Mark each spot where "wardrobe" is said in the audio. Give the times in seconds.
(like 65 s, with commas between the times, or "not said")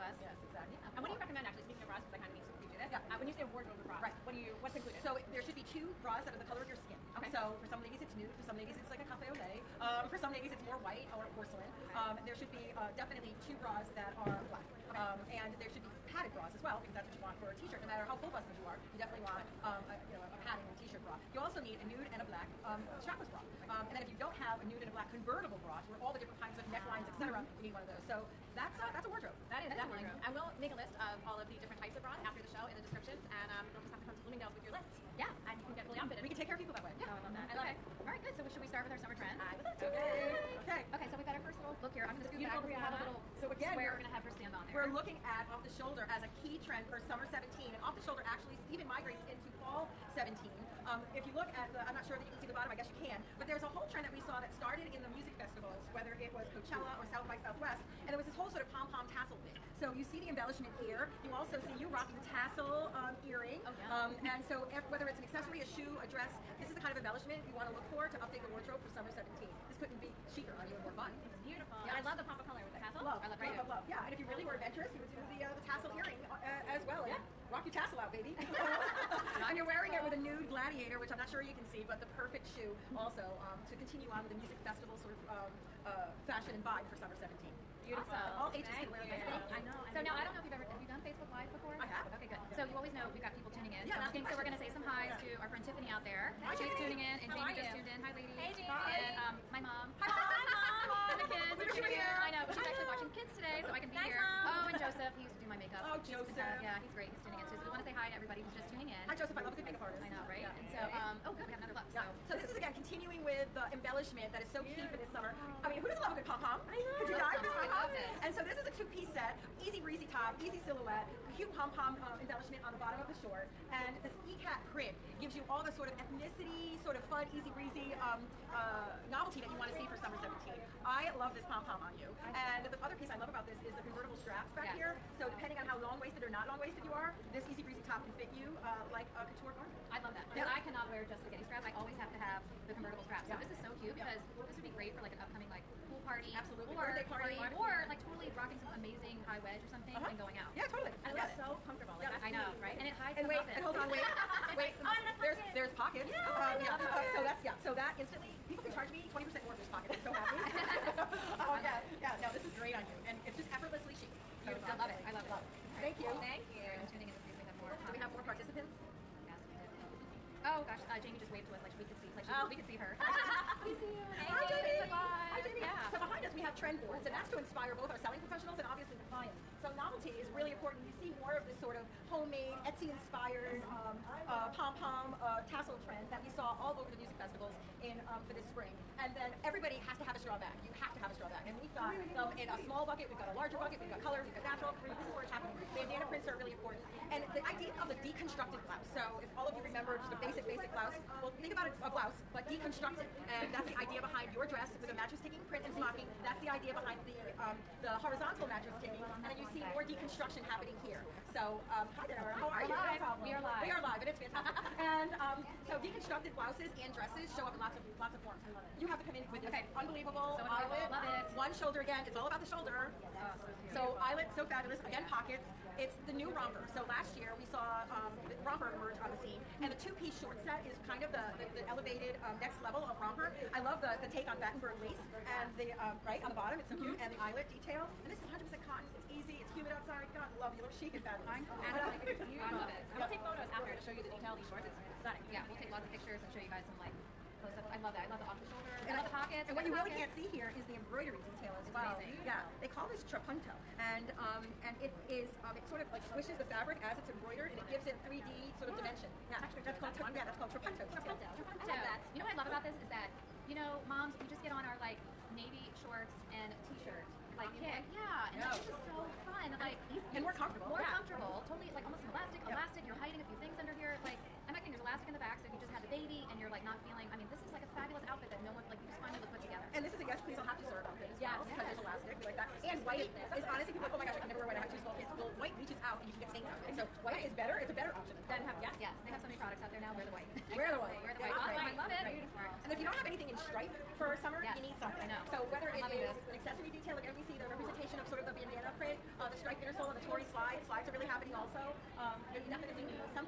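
3 s, 29 s, 68 s.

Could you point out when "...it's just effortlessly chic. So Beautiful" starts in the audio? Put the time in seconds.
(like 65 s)
163 s.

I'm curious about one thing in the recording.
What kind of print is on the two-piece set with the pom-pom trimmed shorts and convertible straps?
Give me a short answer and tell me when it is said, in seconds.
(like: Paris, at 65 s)
Ikat, at 124 s.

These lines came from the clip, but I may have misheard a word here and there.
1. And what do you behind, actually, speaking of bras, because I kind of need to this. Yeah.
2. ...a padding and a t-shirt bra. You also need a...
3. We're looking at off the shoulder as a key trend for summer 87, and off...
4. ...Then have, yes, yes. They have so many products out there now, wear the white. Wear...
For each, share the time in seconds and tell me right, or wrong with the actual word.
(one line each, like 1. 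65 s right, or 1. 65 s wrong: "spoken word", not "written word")
1. 0 s wrong: "recommend", not "behind"
2. 20 s right
3. 44 s wrong: "17", not "87"
4. 288 s right.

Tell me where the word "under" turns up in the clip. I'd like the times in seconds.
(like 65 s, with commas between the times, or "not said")
273 s.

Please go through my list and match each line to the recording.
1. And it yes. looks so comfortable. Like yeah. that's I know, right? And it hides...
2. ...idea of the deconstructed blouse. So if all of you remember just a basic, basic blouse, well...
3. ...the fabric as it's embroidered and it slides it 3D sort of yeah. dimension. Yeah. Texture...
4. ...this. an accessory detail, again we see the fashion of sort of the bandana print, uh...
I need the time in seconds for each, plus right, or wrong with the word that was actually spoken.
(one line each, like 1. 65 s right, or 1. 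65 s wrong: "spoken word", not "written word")
1. 151 s right
2. 197 s right
3. 256 s wrong: "gives", not "slides"
4. 296 s wrong: "representation", not "fashion".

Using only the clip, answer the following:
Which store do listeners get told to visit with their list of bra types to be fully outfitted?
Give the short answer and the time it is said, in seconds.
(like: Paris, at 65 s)
Bloomingdale's, at 34 s.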